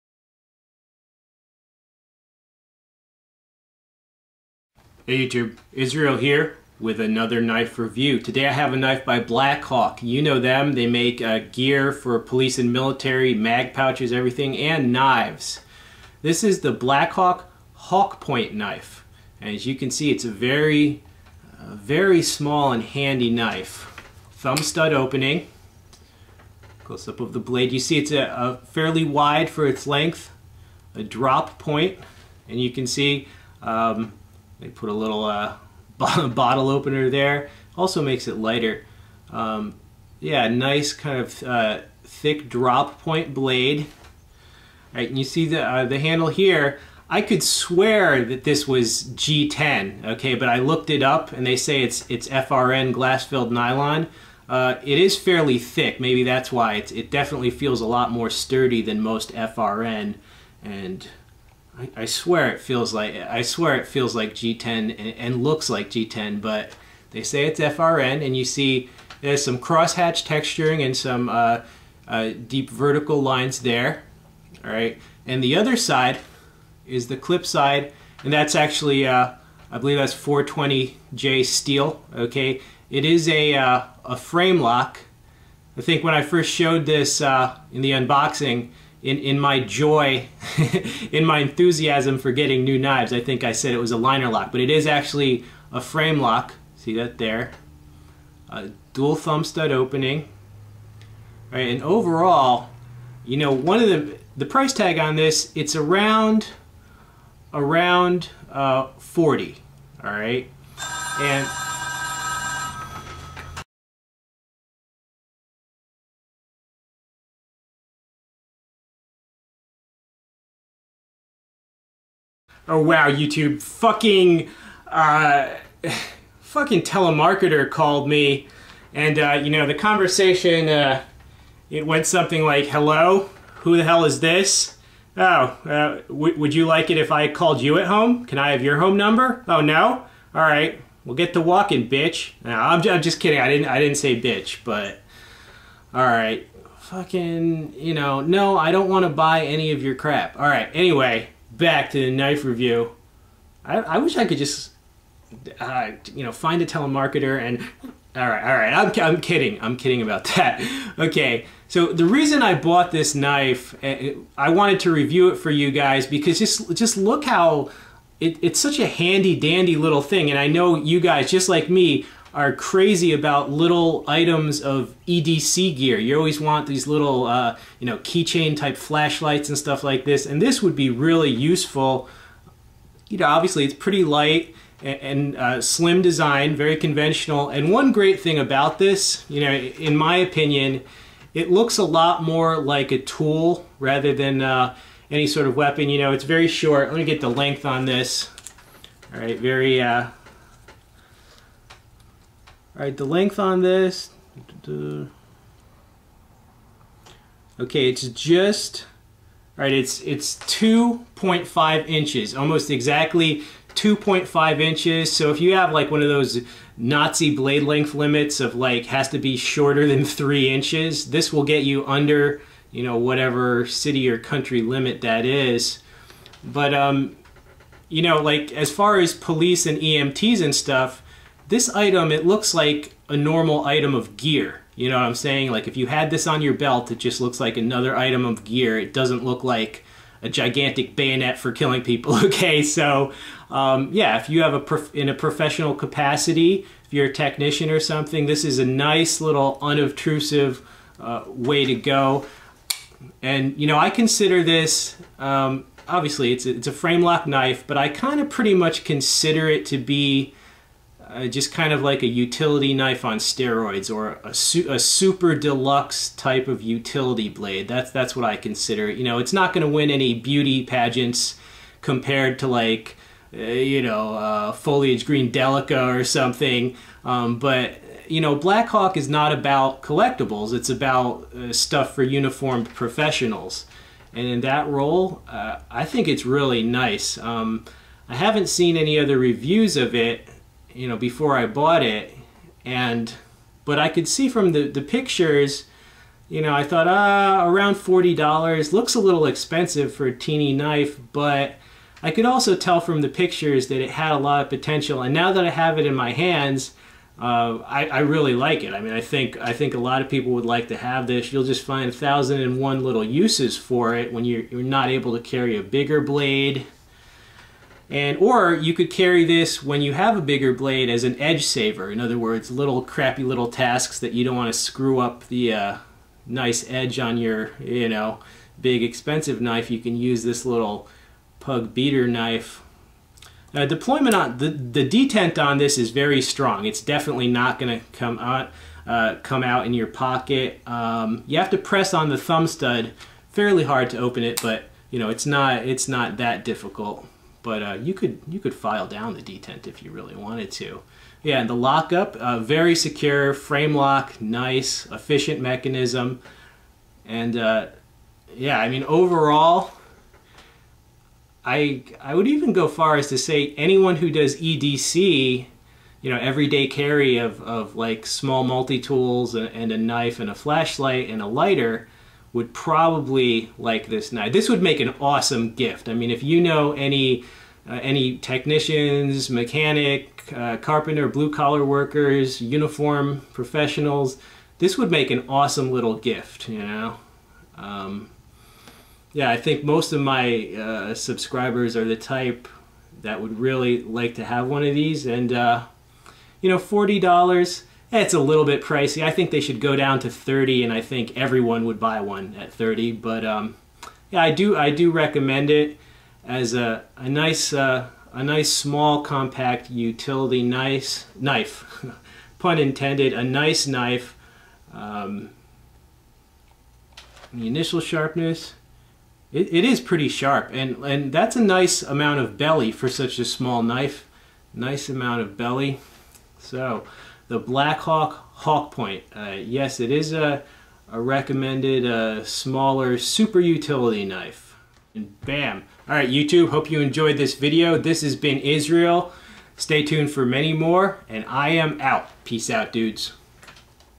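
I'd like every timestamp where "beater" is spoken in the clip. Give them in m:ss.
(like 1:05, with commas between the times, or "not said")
5:31.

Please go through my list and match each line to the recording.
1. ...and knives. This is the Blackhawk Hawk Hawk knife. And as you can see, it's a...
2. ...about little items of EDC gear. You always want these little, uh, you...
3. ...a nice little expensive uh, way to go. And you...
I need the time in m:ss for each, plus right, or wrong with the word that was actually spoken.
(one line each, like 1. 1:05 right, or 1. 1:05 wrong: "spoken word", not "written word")
1. 0:14 wrong: "Point", not "Hawk"
2. 2:53 right
3. 4:08 wrong: "unobtrusive", not "expensive".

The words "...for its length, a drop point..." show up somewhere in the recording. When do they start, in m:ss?
0:29.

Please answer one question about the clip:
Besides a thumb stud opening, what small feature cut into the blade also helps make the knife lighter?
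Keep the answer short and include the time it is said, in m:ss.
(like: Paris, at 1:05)
bottle opener, at 0:35.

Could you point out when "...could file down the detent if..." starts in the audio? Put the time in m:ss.
5:48.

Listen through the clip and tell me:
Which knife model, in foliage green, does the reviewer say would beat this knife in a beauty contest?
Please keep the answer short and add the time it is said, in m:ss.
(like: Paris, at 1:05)
Delica, at 4:35.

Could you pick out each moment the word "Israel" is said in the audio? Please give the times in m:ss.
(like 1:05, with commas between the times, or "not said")
0:05, 7:18.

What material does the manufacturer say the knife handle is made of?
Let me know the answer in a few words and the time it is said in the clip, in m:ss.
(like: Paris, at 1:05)
FRN glass-filled nylon, at 0:52.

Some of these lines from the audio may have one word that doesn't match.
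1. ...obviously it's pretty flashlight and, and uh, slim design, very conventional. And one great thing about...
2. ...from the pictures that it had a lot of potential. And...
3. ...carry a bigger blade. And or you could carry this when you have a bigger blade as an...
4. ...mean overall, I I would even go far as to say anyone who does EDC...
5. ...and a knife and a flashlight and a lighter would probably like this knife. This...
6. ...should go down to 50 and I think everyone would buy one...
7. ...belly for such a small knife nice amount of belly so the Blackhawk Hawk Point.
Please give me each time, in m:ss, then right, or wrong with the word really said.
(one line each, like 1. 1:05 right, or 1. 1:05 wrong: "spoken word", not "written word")
1. 3:03 wrong: "light", not "flashlight"
2. 5:02 right
3. 5:15 right
4. 5:58 right
5. 6:09 right
6. 6:39 wrong: "30", not "50"
7. 7:02 right.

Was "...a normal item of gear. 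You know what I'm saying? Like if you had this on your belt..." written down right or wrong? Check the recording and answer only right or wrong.
right.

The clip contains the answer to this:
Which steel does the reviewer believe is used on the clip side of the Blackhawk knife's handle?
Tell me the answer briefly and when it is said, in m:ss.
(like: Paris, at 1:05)
420J, at 1:20.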